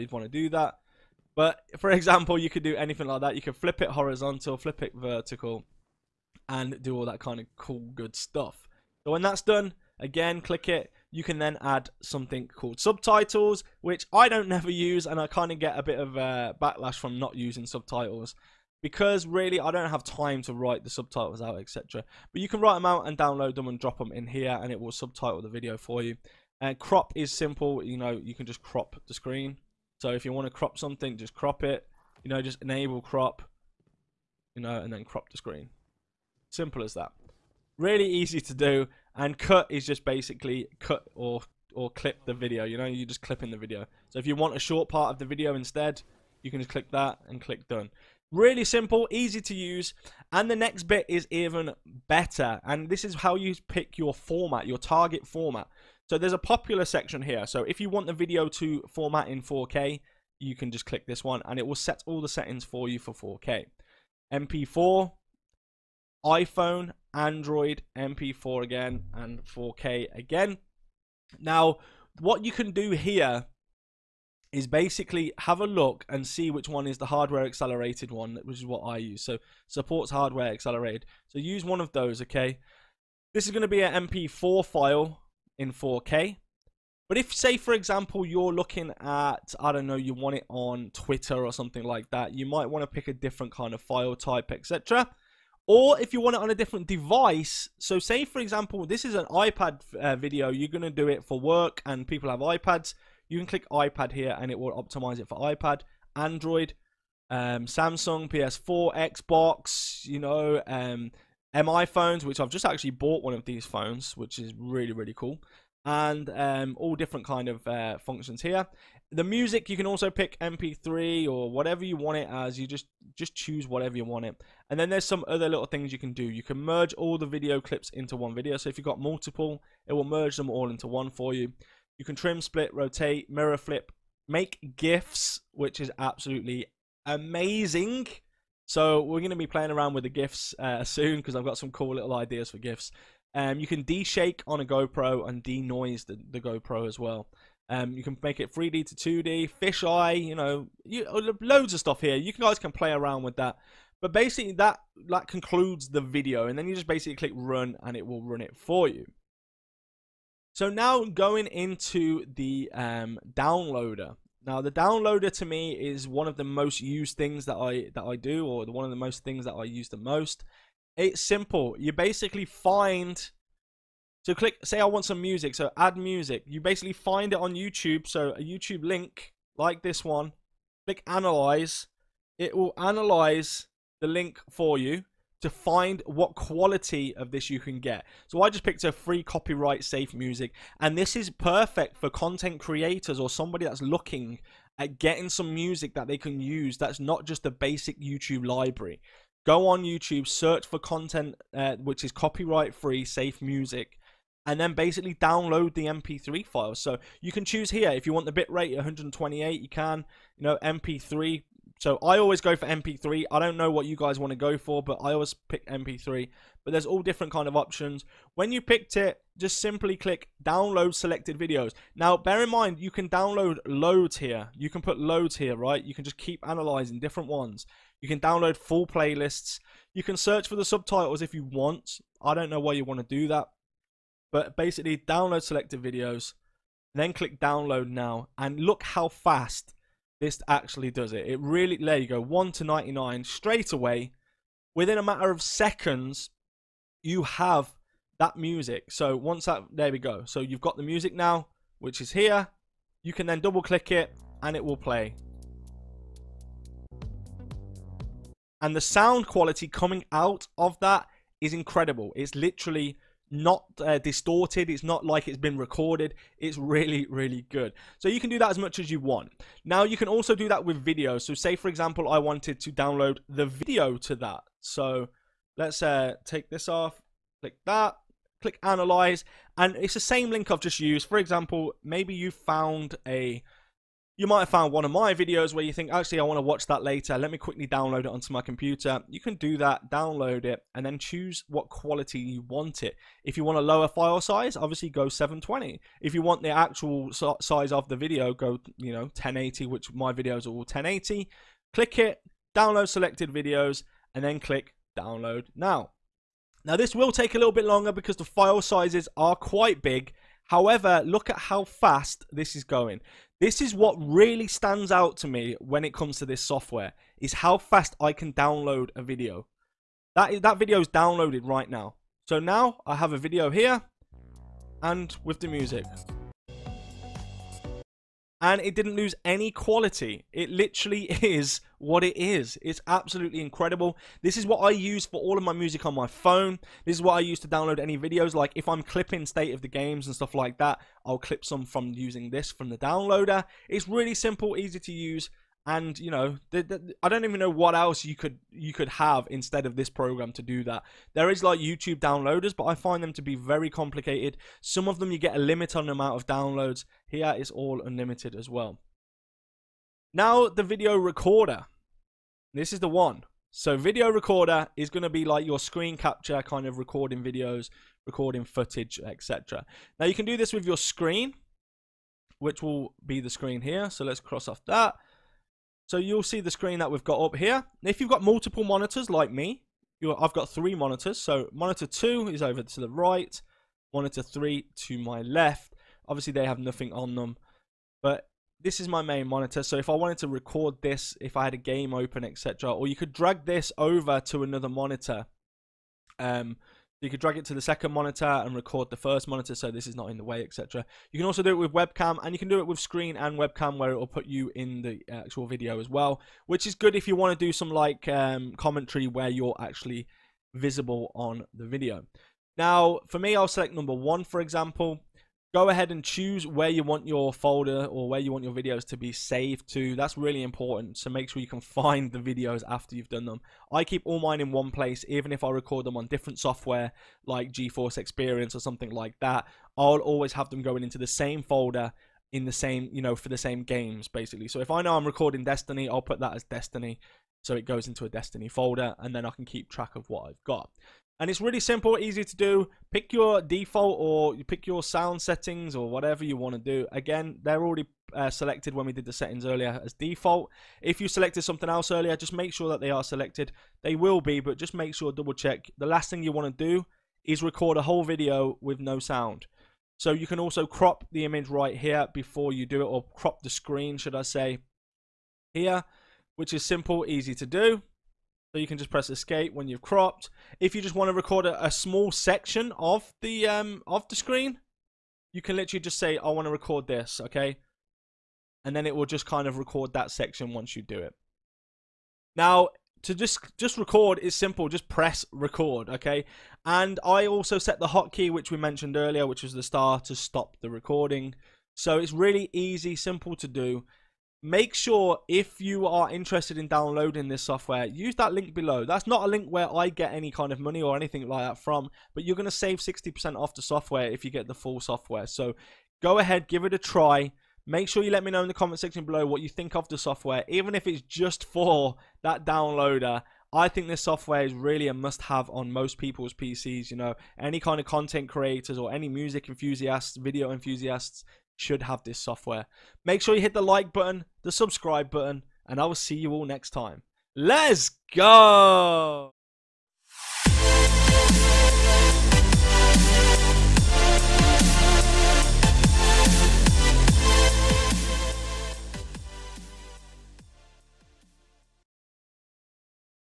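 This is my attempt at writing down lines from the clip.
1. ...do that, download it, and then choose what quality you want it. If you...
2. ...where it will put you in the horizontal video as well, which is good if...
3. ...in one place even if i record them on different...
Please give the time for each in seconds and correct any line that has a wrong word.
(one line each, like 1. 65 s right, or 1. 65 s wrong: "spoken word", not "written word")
1. 289 s right
2. 403 s wrong: "actual", not "horizontal"
3. 424 s right.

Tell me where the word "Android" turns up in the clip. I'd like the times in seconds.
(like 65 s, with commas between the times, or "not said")
67 s, 106 s.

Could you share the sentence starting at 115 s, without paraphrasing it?
And um, all different kind of uh, functions here.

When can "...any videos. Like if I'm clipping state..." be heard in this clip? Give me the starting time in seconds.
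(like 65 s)
337 s.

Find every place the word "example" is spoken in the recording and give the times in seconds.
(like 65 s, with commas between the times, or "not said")
1 s, 87 s, 98 s, 271 s, 281 s, 414 s.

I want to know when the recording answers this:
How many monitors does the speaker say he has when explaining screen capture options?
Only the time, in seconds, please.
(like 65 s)
380 s.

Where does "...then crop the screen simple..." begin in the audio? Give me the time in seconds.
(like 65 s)
34 s.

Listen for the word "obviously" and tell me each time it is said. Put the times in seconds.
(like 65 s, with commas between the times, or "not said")
294 s, 386 s.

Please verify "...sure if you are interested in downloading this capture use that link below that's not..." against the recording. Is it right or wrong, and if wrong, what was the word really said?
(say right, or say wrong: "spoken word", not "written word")
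wrong: "software", not "capture".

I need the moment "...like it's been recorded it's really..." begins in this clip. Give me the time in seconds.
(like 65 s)
265 s.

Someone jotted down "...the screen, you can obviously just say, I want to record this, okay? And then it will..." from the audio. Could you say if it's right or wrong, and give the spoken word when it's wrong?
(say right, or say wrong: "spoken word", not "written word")
wrong: "literally", not "obviously".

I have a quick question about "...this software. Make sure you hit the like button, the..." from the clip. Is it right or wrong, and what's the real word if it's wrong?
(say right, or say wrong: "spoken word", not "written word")
right.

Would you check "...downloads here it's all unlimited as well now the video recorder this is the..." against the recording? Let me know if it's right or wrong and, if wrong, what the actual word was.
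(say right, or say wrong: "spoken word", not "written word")
right.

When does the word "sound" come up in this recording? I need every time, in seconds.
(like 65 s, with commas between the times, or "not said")
258 s, 444 s, 458 s.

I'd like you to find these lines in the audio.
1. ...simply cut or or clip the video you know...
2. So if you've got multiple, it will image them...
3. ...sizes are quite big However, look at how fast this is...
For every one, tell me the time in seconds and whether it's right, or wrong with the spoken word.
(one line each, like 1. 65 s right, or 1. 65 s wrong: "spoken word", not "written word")
1. 40 s wrong: "basically", not "simply"
2. 128 s wrong: "merge", not "image"
3. 308 s right.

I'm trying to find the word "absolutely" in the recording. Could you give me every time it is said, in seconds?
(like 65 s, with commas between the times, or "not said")
135 s, 332 s.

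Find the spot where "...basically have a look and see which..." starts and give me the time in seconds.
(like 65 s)
74 s.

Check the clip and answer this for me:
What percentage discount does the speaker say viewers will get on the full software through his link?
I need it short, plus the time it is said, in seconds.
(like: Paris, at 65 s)
60%, at 502 s.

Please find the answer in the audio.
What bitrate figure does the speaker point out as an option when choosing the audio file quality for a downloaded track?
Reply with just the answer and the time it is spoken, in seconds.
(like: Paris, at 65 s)
128, at 208 s.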